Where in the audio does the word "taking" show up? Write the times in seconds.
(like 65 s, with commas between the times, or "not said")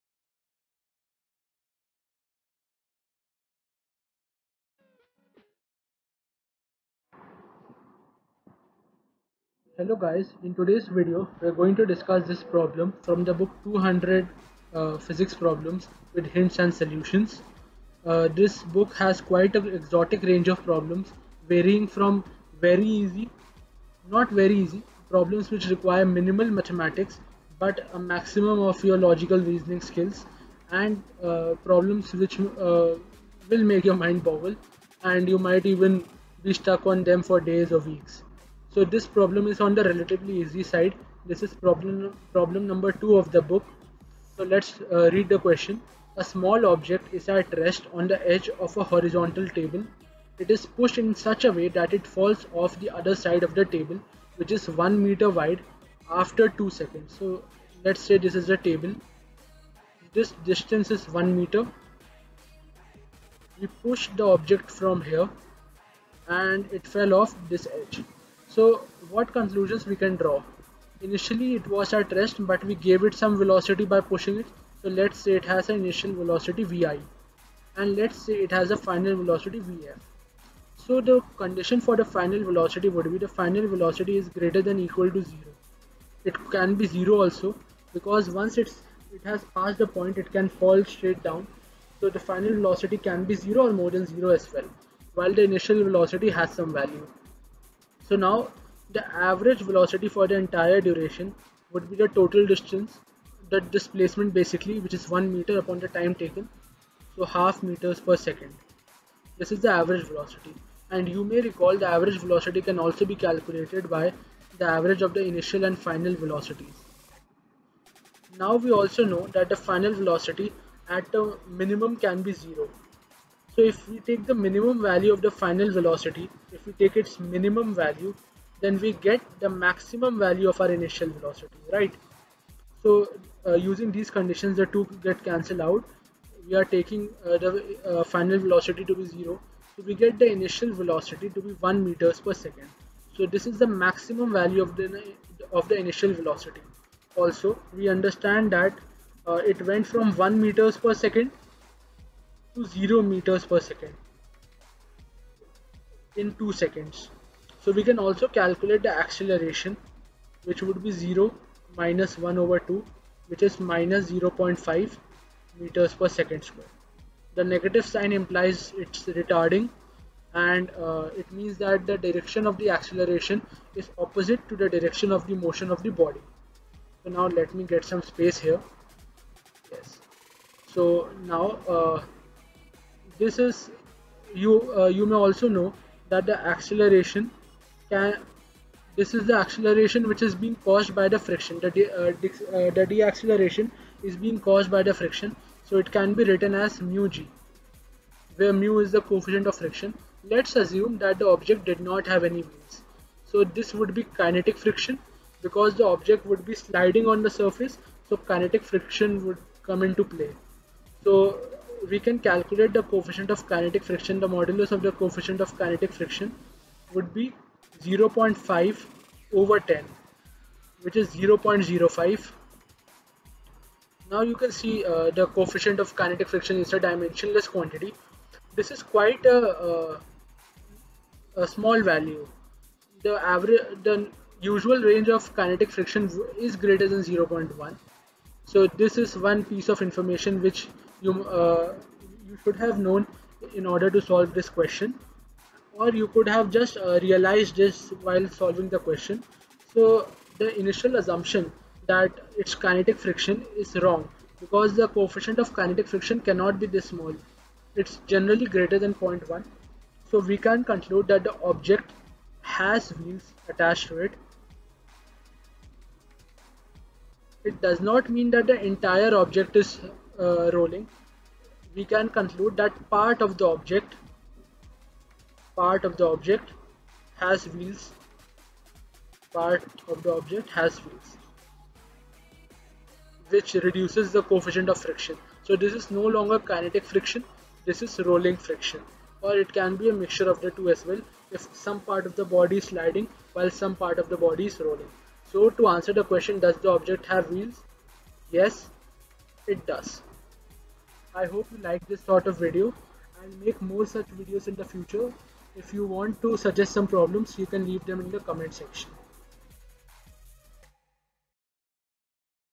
136 s.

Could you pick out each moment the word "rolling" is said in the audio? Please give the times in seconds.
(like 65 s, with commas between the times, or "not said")
270 s, 288 s, 294 s.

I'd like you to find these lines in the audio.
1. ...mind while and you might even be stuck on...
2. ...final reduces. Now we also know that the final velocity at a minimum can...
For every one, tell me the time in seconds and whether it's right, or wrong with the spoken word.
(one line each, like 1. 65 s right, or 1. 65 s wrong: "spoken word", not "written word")
1. 33 s wrong: "boggle", not "while"
2. 115 s wrong: "velocities", not "reduces".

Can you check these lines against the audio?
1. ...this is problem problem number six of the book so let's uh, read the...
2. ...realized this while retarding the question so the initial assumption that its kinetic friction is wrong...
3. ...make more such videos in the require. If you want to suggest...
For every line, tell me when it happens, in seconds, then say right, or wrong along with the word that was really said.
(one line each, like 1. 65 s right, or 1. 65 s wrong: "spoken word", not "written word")
1. 41 s wrong: "two", not "six"
2. 247 s wrong: "solving", not "retarding"
3. 303 s wrong: "future", not "require".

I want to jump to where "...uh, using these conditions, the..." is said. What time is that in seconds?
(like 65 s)
133 s.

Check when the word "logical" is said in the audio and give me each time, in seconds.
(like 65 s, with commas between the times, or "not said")
28 s.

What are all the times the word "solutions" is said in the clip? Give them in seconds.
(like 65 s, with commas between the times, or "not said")
16 s.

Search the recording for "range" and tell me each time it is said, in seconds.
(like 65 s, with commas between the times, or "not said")
20 s, 234 s.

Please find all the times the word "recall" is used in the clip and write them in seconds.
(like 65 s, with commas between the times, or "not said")
111 s.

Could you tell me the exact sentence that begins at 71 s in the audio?
Initially it was at rest but we gave it some velocity by pushing it.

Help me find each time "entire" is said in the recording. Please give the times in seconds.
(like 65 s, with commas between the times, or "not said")
100 s, 268 s.